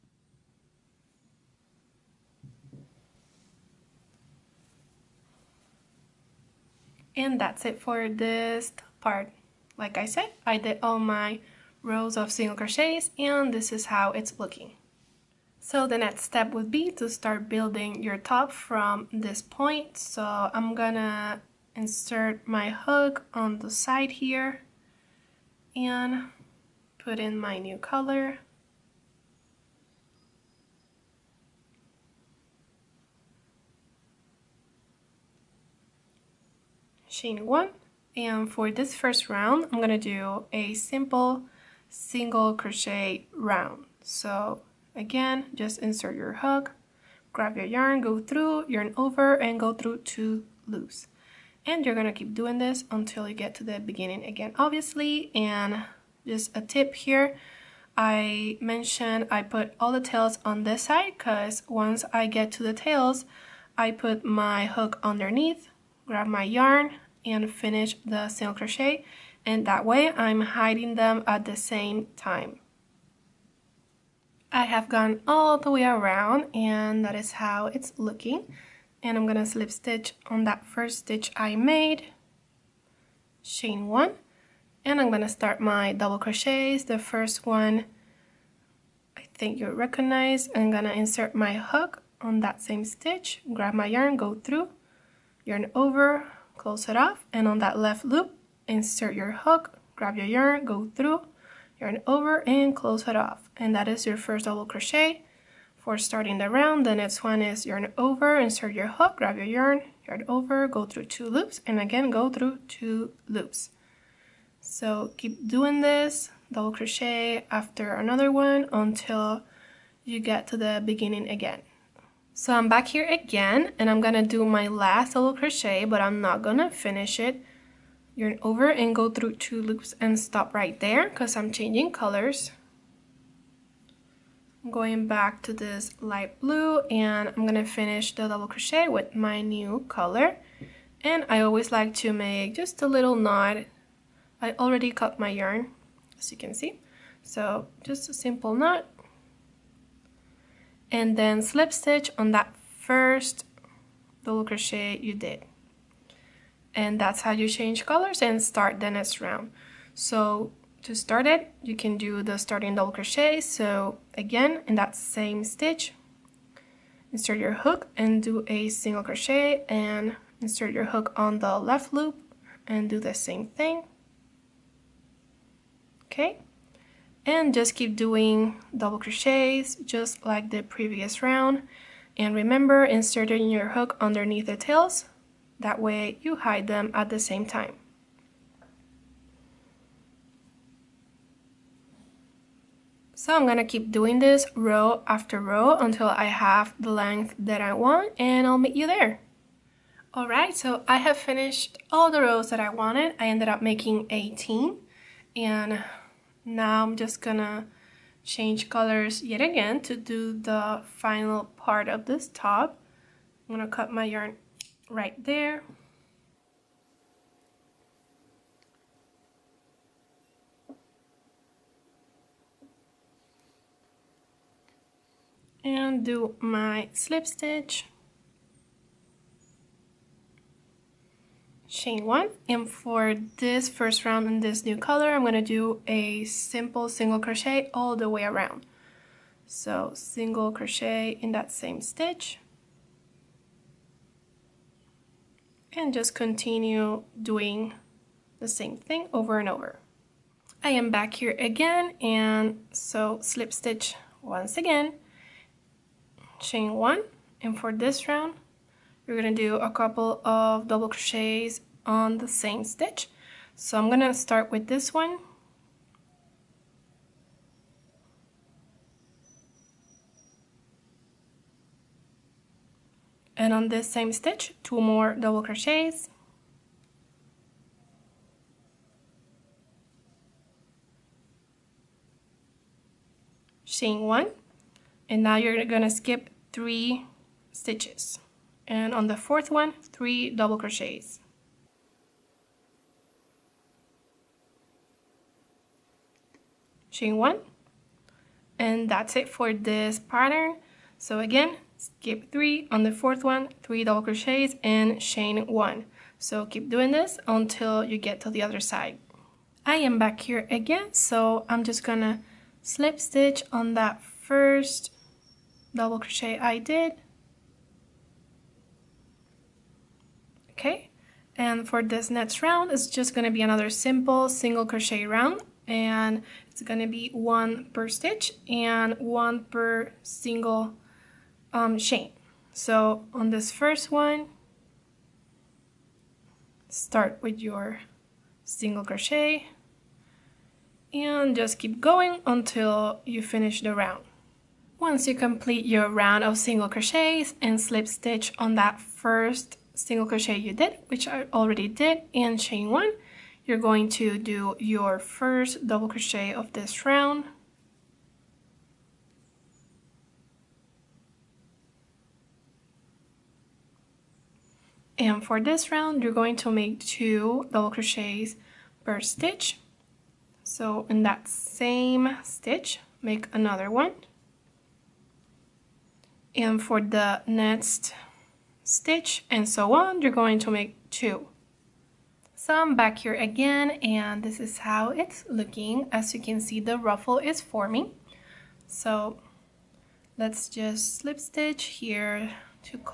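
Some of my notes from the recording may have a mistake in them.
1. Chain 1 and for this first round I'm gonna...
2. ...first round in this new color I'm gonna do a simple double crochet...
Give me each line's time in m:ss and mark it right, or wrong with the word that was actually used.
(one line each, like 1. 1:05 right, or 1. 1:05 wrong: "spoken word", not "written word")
1. 0:37 right
2. 3:53 wrong: "single", not "double".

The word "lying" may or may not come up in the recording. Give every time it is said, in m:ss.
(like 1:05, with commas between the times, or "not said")
not said.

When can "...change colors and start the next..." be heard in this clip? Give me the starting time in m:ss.
2:37.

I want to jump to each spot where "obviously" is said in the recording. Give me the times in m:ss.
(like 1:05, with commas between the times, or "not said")
0:54.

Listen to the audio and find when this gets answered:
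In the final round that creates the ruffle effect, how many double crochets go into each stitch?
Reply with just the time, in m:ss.
6:06.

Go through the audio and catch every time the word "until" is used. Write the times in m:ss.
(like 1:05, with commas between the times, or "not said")
0:52, 1:58, 3:15, 5:07, 5:42.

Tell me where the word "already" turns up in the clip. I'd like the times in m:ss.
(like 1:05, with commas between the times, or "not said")
2:24, 5:51.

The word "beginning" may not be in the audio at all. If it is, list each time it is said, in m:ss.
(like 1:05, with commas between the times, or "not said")
0:53, 2:00.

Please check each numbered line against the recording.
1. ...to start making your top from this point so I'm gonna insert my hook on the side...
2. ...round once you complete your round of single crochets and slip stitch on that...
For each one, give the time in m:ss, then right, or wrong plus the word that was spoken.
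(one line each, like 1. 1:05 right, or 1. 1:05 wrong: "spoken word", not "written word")
1. 0:16 wrong: "building", not "making"
2. 5:43 right.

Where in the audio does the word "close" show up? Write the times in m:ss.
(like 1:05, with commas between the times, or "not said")
1:36, 1:42.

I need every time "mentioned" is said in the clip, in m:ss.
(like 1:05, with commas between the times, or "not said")
0:58.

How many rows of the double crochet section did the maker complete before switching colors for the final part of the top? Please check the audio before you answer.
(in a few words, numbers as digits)
18.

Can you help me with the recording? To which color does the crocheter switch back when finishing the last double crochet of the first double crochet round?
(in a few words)
light blue.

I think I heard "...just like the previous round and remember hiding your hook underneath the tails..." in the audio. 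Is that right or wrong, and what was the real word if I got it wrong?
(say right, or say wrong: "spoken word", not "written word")
wrong: "inserting", not "hiding".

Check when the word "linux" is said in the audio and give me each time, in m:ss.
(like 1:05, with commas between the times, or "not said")
not said.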